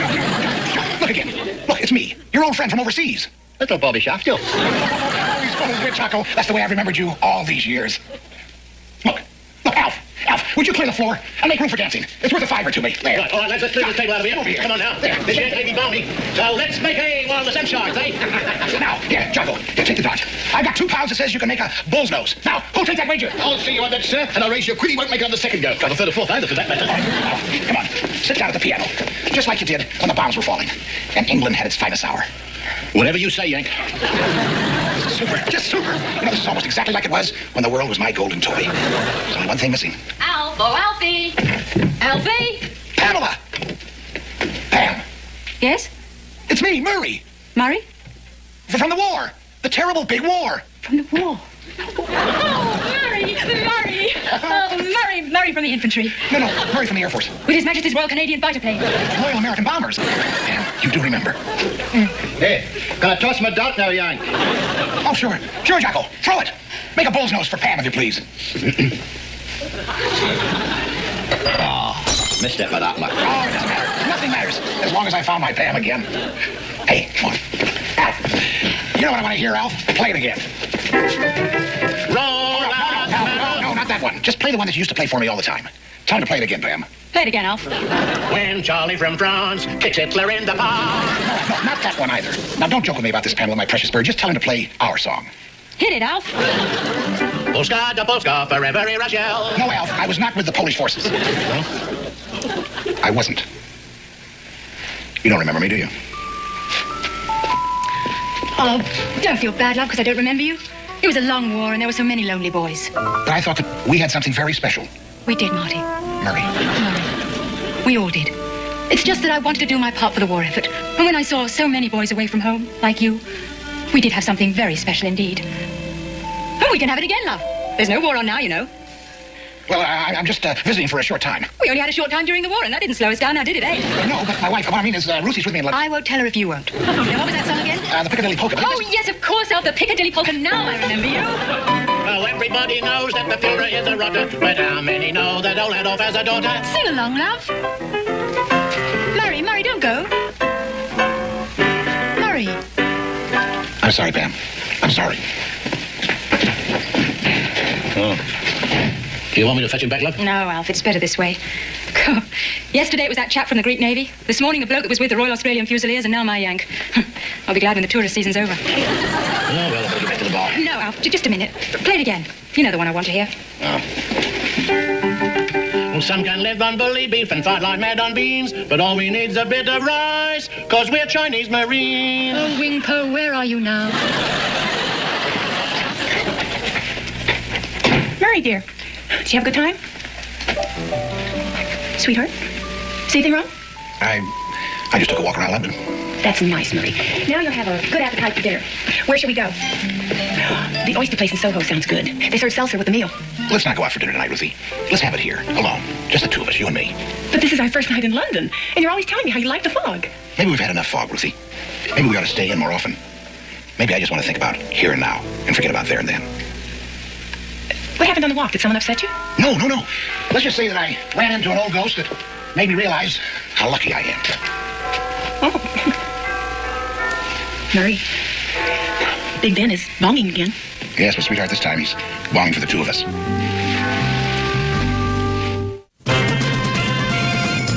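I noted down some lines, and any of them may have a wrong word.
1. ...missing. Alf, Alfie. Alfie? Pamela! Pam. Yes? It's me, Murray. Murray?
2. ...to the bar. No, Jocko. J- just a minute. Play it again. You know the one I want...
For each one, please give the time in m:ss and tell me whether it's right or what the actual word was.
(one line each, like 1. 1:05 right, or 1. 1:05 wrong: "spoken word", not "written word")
1. 0:39 right
2. 2:50 wrong: "Alf", not "Jocko".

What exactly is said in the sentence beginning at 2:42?
Yesterday it was that chap from the Greek Navy.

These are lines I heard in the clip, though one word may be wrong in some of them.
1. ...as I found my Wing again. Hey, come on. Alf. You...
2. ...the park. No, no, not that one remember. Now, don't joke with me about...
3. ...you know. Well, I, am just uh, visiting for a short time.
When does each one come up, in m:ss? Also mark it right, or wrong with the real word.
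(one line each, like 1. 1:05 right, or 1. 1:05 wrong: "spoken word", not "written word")
1. 1:15 wrong: "Pam", not "Wing"
2. 1:30 wrong: "either", not "remember"
3. 2:08 right.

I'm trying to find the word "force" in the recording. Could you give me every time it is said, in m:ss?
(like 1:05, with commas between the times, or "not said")
0:57, 1:40.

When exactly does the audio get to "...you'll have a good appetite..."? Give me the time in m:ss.
3:17.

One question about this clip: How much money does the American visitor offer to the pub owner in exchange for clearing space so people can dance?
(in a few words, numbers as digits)
a fiver.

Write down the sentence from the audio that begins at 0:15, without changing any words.
may be balmy, so let's make a the sunshine, eh?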